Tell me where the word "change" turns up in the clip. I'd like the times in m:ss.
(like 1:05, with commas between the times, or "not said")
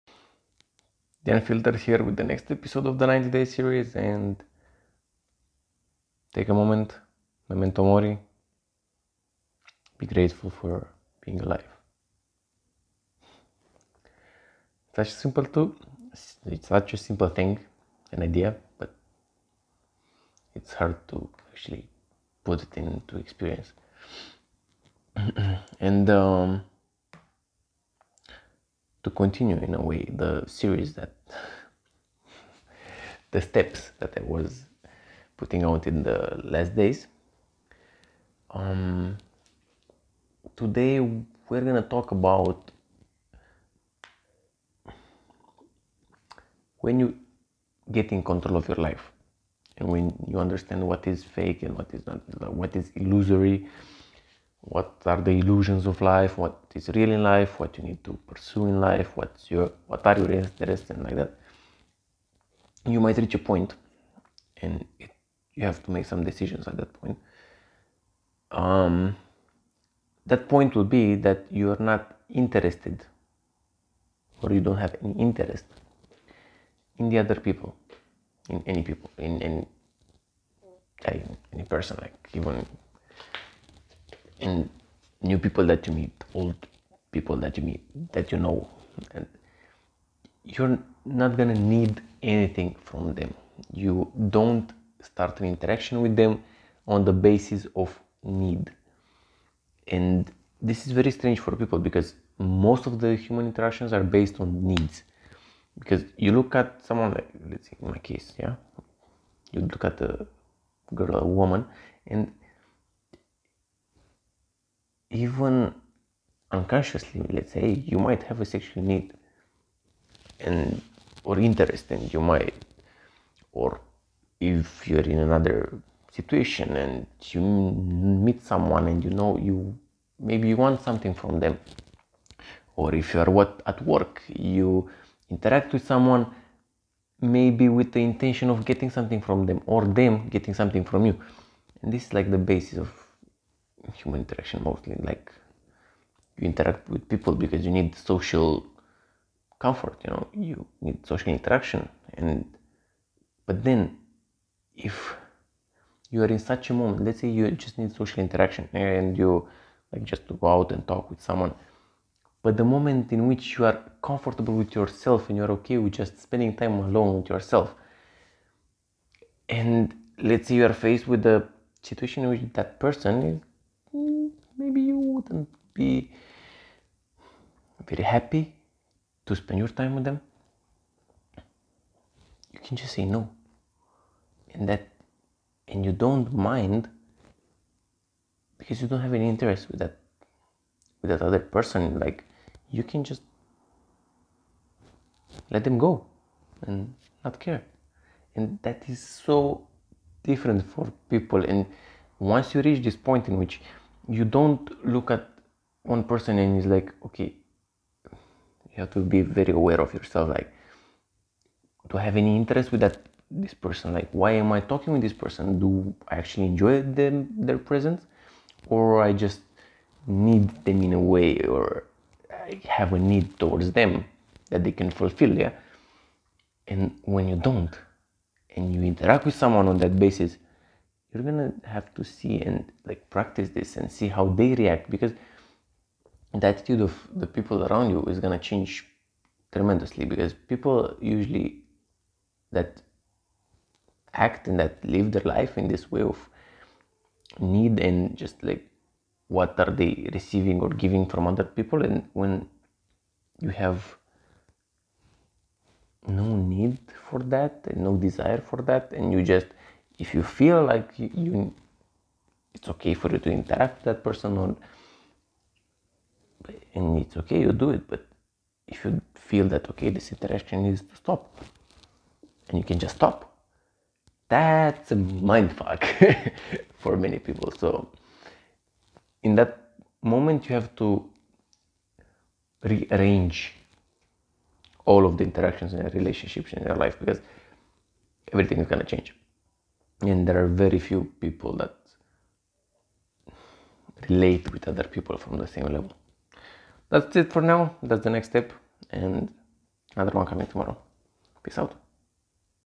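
3:58, 4:48.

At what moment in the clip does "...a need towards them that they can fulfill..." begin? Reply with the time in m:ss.
3:42.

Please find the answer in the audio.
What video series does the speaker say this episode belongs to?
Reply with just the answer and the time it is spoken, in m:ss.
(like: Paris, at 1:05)
90 Day series, at 0:03.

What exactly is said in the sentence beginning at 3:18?
And that is so different for people.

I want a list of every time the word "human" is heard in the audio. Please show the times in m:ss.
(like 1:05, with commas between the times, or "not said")
1:43, 2:23.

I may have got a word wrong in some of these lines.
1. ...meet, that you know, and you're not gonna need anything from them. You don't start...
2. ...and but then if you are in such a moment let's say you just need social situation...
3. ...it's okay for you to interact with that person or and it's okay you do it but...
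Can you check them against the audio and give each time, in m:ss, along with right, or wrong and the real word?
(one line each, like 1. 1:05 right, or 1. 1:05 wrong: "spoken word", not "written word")
1. 1:27 right
2. 2:32 wrong: "interaction", not "situation"
3. 4:22 right.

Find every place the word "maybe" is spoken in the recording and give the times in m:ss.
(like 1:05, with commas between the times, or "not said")
2:10, 2:17.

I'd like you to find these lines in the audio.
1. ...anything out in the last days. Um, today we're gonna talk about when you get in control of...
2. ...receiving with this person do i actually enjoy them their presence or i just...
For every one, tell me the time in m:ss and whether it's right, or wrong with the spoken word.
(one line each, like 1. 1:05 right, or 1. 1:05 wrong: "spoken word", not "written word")
1. 0:35 wrong: "putting", not "anything"
2. 3:34 wrong: "talking", not "receiving".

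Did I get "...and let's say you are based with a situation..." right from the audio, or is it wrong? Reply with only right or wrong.
wrong.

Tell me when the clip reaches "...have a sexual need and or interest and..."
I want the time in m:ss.
1:58.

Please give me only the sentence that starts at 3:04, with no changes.
And that, and you don't mind because you don't have any interest with that, with that other person.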